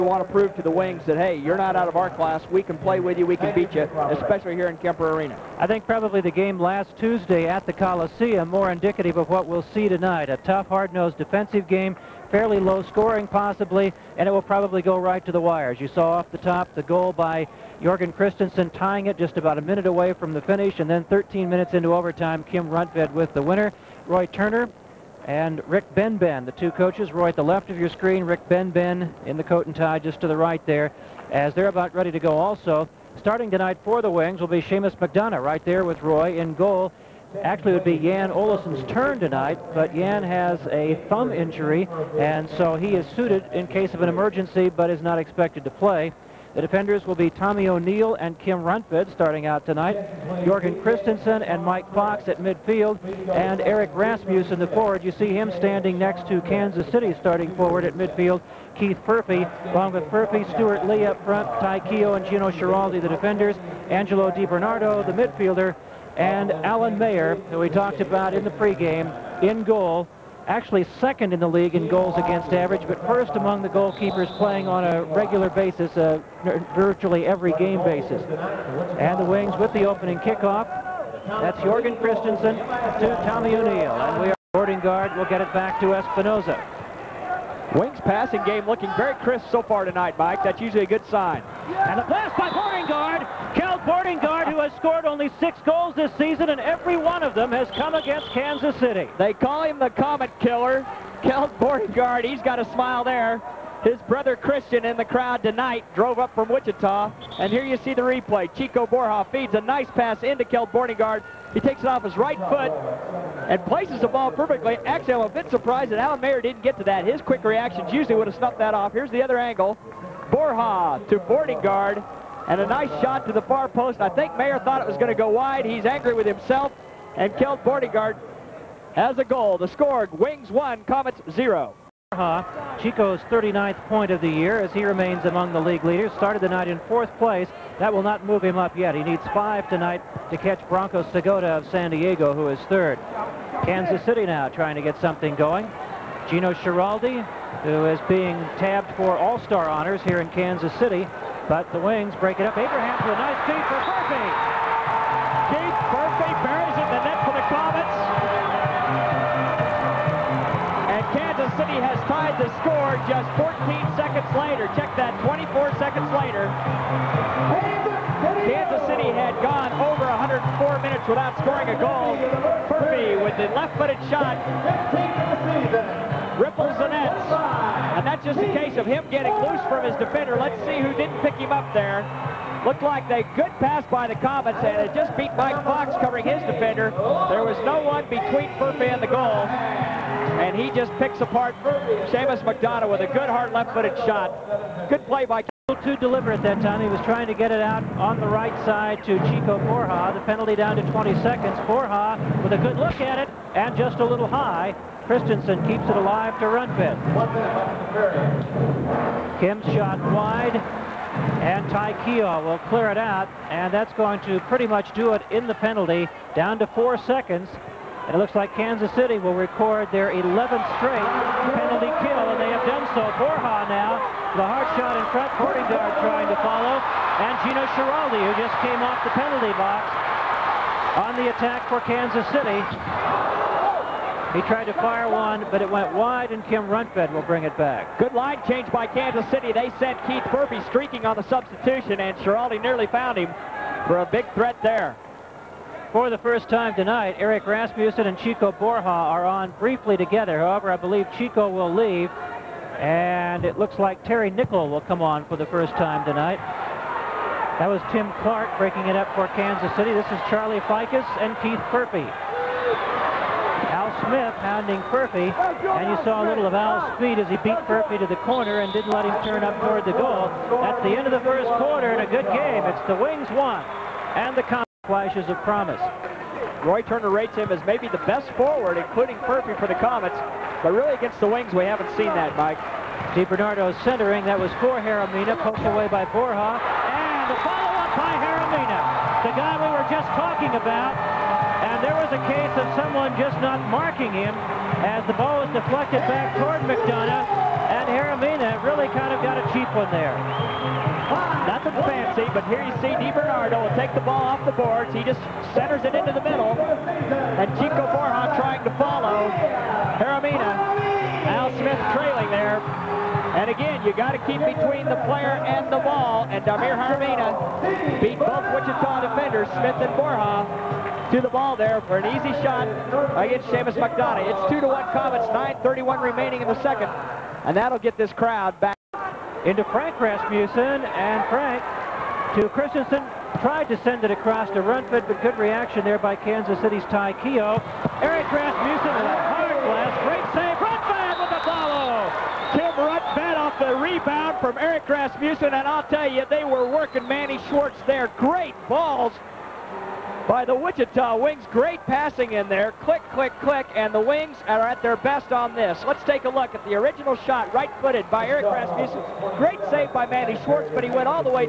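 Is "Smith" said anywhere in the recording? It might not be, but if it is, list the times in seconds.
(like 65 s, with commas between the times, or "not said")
264 s, 311 s, 319 s.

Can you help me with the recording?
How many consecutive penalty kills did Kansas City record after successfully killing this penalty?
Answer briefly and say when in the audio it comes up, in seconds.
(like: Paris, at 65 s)
11, at 220 s.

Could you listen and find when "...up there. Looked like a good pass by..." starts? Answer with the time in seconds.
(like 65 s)
181 s.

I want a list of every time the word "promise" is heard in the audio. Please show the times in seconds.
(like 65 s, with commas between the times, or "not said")
275 s.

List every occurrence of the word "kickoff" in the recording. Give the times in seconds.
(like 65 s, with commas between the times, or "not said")
80 s.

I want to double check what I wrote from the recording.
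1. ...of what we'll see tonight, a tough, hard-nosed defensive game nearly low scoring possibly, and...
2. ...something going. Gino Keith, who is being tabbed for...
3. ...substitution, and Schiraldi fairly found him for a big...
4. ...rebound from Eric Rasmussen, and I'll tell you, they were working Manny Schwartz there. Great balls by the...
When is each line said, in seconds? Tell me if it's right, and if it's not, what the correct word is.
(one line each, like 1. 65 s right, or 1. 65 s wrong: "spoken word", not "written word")
1. 9 s wrong: "fairly", not "nearly"
2. 145 s wrong: "Schiraldi", not "Keith"
3. 241 s wrong: "nearly", not "fairly"
4. 343 s right.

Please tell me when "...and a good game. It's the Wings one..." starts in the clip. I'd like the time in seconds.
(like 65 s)
271 s.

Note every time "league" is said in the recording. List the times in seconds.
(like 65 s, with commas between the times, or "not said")
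71 s, 135 s.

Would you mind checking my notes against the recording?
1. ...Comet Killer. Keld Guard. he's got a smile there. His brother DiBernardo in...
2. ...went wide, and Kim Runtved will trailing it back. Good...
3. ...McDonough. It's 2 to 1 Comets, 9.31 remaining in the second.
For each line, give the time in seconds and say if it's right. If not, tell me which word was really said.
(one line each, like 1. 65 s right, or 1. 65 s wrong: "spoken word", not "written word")
1. 99 s wrong: "Christian", not "DiBernardo"
2. 235 s wrong: "bring", not "trailing"
3. 323 s right.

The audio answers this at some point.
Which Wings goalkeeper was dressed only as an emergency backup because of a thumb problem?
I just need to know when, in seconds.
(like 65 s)
37 s.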